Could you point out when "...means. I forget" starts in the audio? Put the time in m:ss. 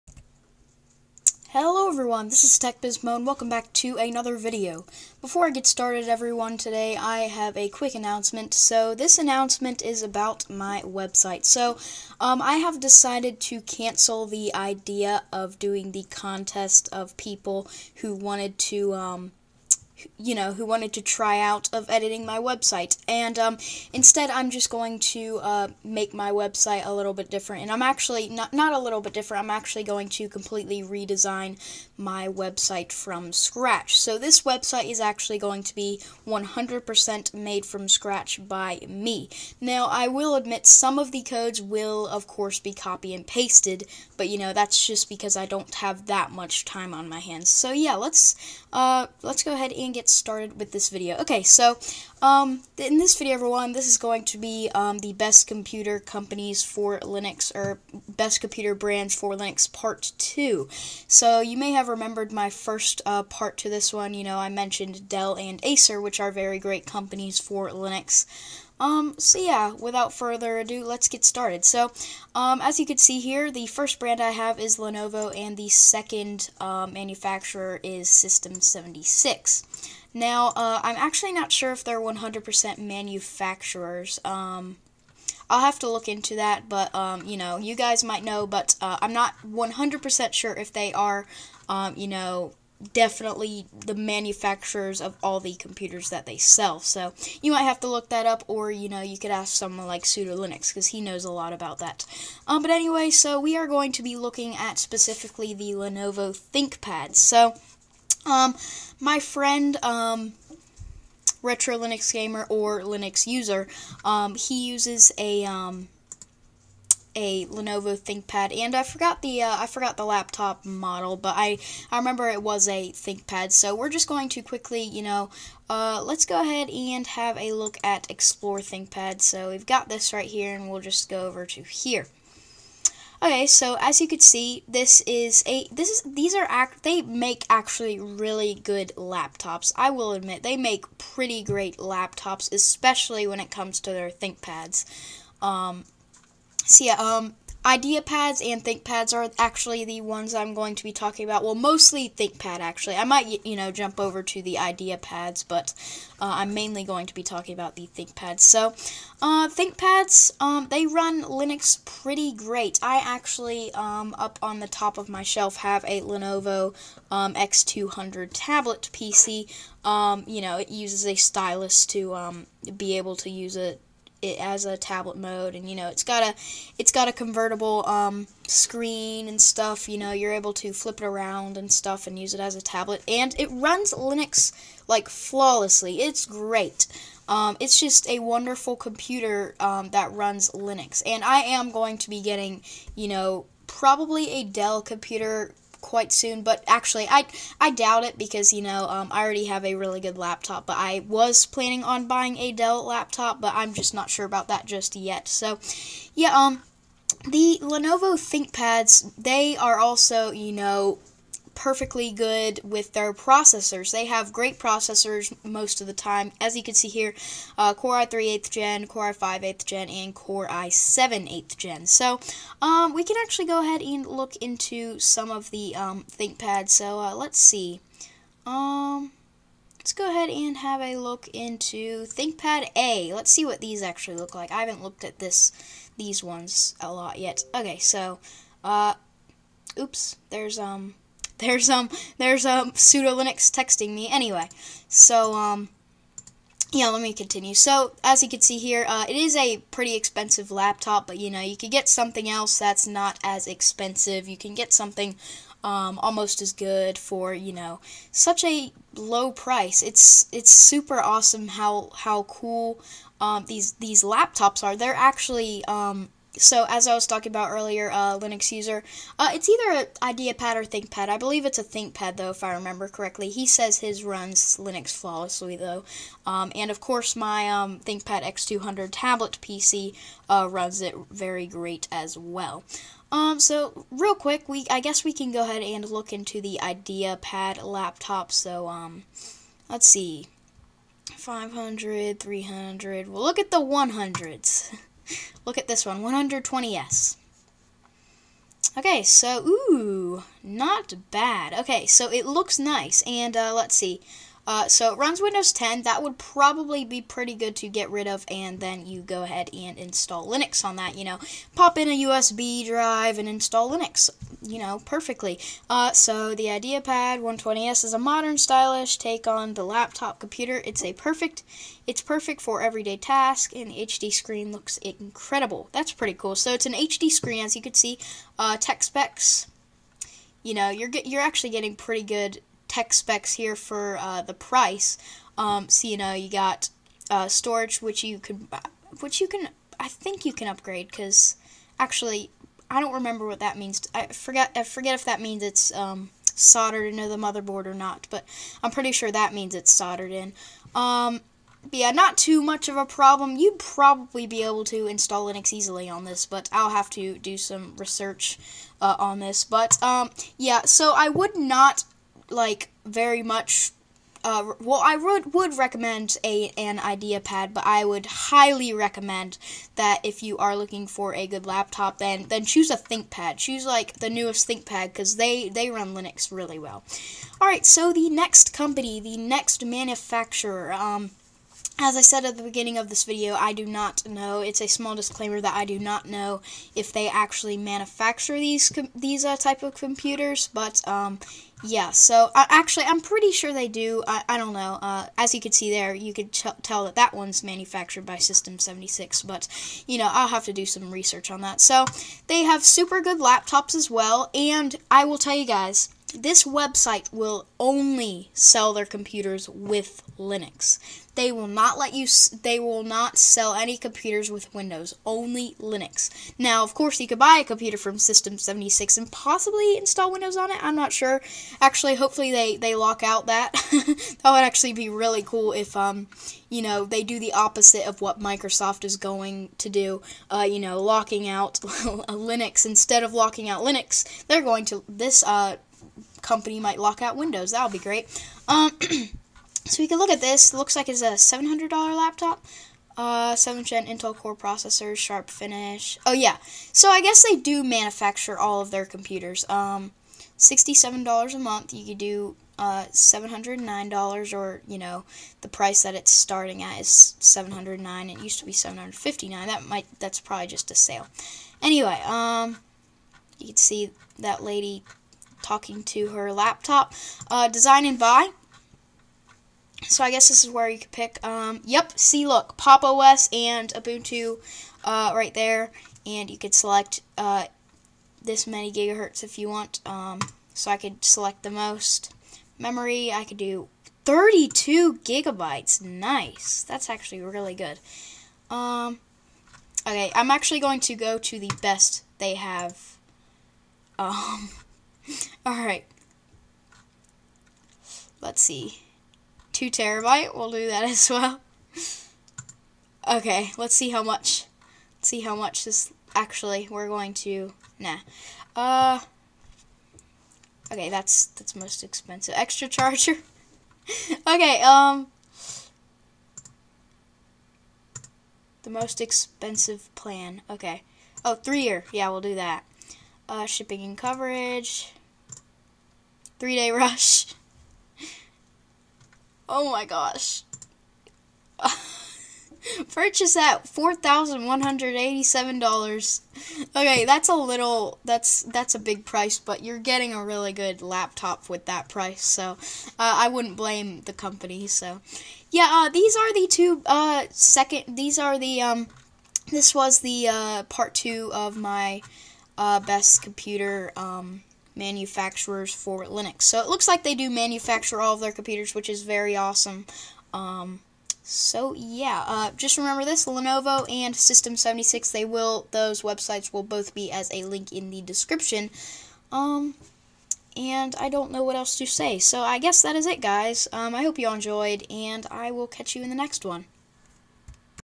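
5:43.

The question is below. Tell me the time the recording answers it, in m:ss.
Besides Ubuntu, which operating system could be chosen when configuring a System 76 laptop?
7:52.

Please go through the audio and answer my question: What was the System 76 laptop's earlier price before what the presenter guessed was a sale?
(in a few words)
$759.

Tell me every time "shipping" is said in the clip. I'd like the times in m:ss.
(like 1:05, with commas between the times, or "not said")
8:43.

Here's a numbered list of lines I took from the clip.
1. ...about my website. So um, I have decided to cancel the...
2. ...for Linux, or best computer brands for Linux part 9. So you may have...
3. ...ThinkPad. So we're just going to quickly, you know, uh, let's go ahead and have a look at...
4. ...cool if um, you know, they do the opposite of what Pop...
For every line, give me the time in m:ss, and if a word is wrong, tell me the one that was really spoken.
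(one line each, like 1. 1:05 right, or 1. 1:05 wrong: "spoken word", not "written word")
1. 0:10 right
2. 0:56 wrong: "2", not "9"
3. 2:02 right
4. 7:05 wrong: "Microsoft", not "Pop".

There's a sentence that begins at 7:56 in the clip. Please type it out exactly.
And you could select uh, this many gigahertz if you want.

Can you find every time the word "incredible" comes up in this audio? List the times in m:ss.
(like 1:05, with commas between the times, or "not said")
5:24.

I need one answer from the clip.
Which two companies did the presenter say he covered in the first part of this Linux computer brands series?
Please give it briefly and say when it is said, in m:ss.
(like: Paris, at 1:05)
Dell and Acer, at 1:05.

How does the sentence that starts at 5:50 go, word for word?
Um, yeah, not too much of a problem.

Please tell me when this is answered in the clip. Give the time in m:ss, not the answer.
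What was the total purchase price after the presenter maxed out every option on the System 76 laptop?
8:53.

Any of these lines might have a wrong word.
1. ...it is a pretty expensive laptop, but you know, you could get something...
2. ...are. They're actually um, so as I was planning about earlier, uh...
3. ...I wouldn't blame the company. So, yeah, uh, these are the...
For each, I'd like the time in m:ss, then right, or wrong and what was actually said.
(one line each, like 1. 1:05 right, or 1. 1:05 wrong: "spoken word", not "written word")
1. 4:09 right
2. 4:24 wrong: "talking", not "planning"
3. 9:03 right.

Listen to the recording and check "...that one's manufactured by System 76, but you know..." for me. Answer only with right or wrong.
right.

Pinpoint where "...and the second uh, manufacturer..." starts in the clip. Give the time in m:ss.
1:15.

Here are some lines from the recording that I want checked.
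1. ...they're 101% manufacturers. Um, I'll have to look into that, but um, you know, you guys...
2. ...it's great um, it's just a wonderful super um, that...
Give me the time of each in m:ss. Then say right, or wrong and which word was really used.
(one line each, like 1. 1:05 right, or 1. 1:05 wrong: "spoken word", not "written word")
1. 1:21 wrong: "100", not "101"
2. 3:06 wrong: "computer", not "super".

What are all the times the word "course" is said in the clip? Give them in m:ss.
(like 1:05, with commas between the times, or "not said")
0:42, 4:36, 6:56.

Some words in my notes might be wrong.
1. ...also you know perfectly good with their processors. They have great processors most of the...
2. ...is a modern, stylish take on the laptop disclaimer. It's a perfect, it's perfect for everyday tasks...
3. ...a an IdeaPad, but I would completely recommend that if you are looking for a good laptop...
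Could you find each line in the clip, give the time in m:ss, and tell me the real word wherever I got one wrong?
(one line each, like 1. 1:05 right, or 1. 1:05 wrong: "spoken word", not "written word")
1. 3:29 right
2. 5:17 wrong: "computer", not "disclaimer"
3. 6:06 wrong: "highly", not "completely".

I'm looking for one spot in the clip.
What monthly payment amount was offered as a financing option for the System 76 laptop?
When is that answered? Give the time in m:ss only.
7:30.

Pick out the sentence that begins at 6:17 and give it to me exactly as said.
All right, so the next company, the next manufacturer.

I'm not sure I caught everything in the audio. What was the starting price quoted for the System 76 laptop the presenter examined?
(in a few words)
$709.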